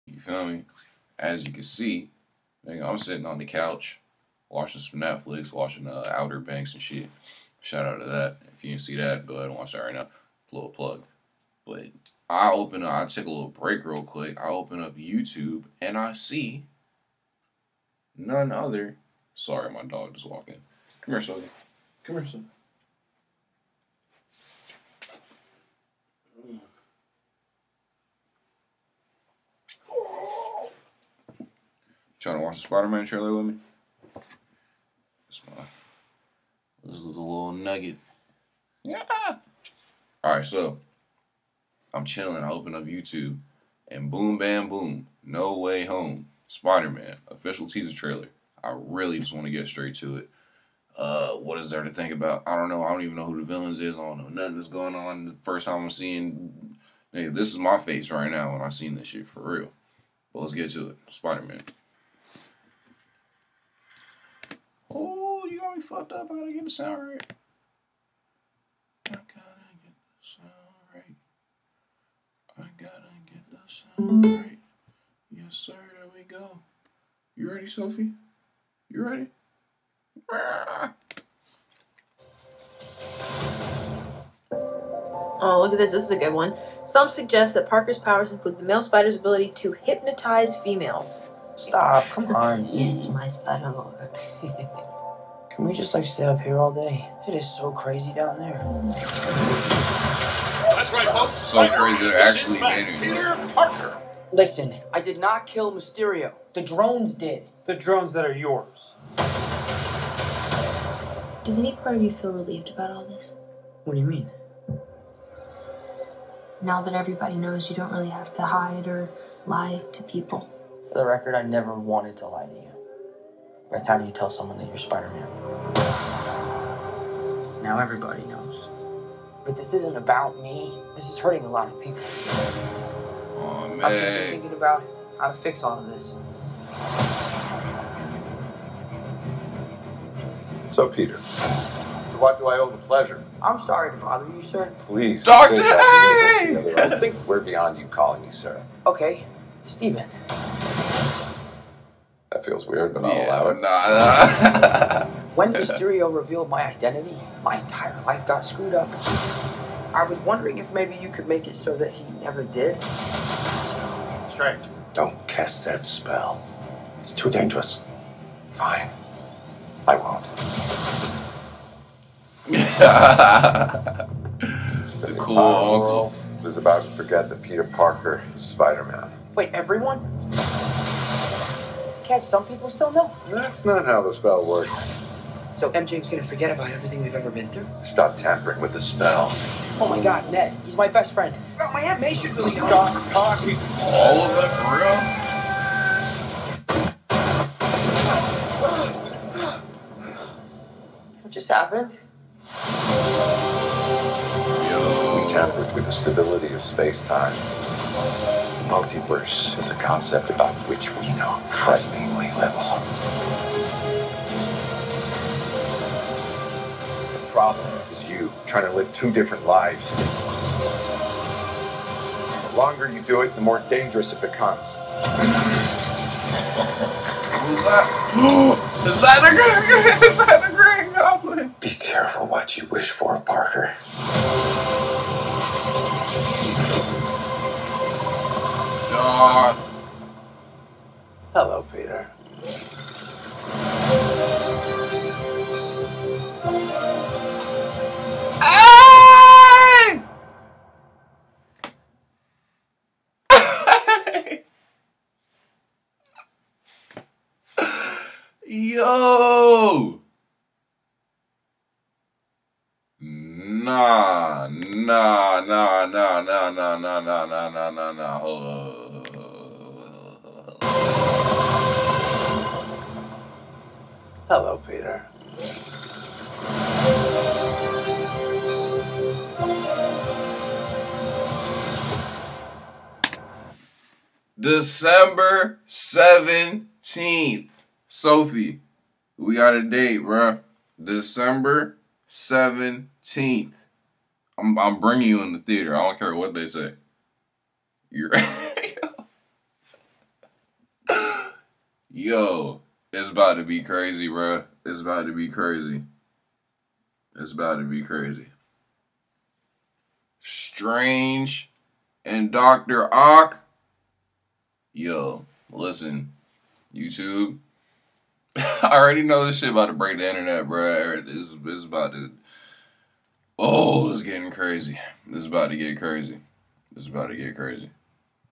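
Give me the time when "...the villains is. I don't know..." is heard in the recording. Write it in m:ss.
0:53.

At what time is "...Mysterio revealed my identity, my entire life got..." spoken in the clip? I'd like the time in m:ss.
2:35.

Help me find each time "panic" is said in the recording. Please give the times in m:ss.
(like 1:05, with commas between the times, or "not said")
not said.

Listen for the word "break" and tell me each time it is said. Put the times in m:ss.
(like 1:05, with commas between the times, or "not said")
0:13, 5:19.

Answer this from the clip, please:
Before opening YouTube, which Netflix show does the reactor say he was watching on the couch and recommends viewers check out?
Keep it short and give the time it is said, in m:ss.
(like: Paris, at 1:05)
Outer Banks, at 0:06.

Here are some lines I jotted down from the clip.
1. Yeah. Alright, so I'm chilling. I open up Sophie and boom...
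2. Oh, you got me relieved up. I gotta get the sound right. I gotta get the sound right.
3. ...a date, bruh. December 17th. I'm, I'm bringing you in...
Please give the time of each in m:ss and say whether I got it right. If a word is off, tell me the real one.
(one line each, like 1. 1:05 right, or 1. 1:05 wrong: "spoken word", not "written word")
1. 0:38 wrong: "YouTube", not "Sophie"
2. 1:04 wrong: "fucked", not "relieved"
3. 4:49 right.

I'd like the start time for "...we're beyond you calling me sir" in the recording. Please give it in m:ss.
2:27.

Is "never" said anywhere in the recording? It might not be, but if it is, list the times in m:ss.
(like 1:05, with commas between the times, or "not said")
2:01, 2:42.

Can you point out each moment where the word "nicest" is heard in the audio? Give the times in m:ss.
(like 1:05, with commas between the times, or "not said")
not said.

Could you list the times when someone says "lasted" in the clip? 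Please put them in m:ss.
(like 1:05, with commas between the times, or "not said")
not said.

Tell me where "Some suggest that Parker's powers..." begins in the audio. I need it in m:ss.
1:26.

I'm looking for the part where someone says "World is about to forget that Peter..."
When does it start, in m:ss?
2:55.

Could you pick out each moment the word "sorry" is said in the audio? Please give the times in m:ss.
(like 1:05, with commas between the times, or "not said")
0:19, 2:23.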